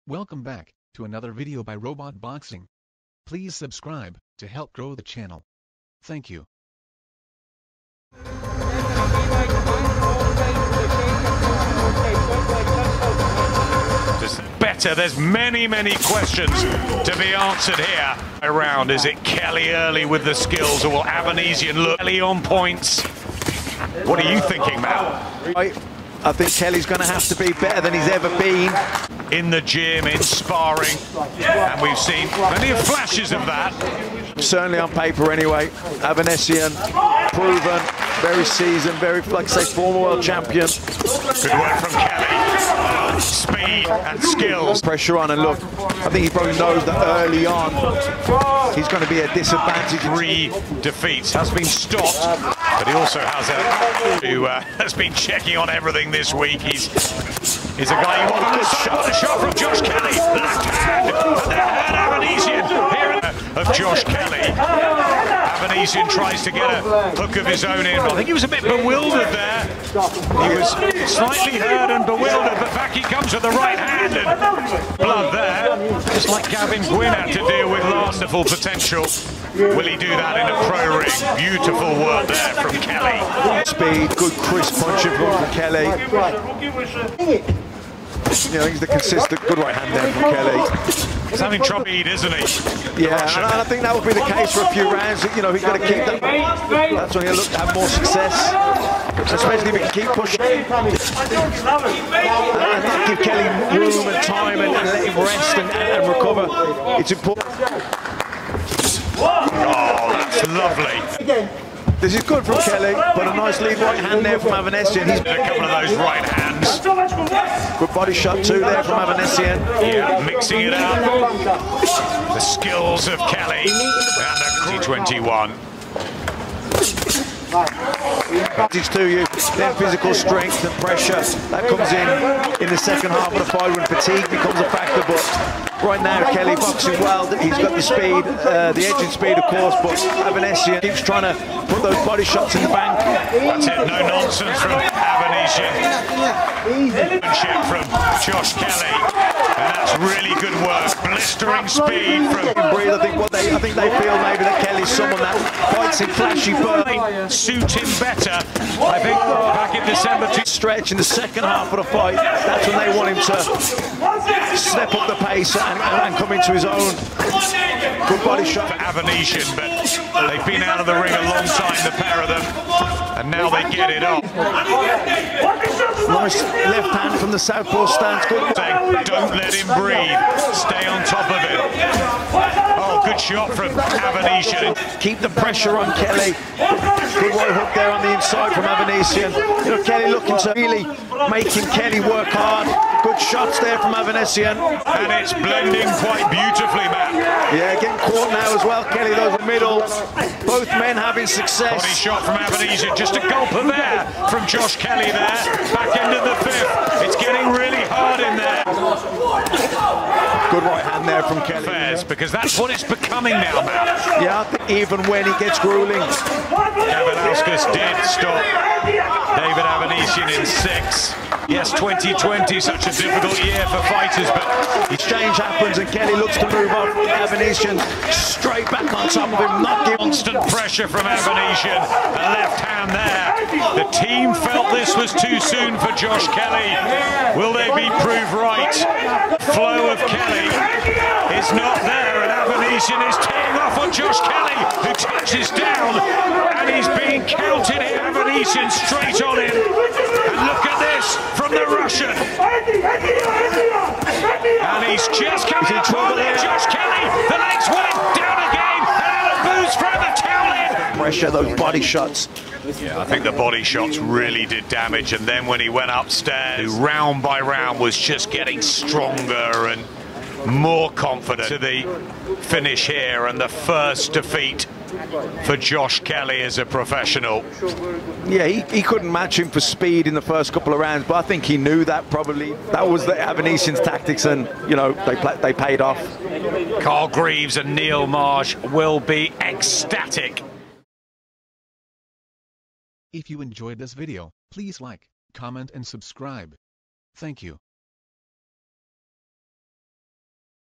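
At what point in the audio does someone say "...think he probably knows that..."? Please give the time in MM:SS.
00:46.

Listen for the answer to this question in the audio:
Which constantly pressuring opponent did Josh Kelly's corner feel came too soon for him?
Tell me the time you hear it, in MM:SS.
03:39.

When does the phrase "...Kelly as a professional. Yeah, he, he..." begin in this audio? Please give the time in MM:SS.
04:36.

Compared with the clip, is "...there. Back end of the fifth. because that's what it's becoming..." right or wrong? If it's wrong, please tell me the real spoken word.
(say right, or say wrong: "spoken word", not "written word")
right.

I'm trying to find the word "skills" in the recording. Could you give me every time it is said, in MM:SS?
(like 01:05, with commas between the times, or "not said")
00:20, 00:44, 02:02.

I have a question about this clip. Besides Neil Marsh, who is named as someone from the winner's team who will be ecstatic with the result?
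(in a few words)
Carl Greaves.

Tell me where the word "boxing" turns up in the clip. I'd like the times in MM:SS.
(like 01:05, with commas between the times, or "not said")
00:02, 02:16.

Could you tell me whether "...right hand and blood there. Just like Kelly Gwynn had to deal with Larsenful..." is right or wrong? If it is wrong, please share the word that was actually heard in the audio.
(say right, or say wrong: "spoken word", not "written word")
wrong: "Gavin", not "Kelly".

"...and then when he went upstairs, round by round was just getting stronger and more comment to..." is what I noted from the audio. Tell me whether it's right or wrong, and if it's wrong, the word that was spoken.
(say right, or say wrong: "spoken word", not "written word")
wrong: "confident", not "comment".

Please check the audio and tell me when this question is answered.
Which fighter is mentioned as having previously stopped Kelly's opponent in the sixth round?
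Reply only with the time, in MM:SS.
03:36.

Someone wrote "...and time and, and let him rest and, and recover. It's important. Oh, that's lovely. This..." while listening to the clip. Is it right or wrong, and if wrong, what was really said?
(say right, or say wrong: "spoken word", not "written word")
right.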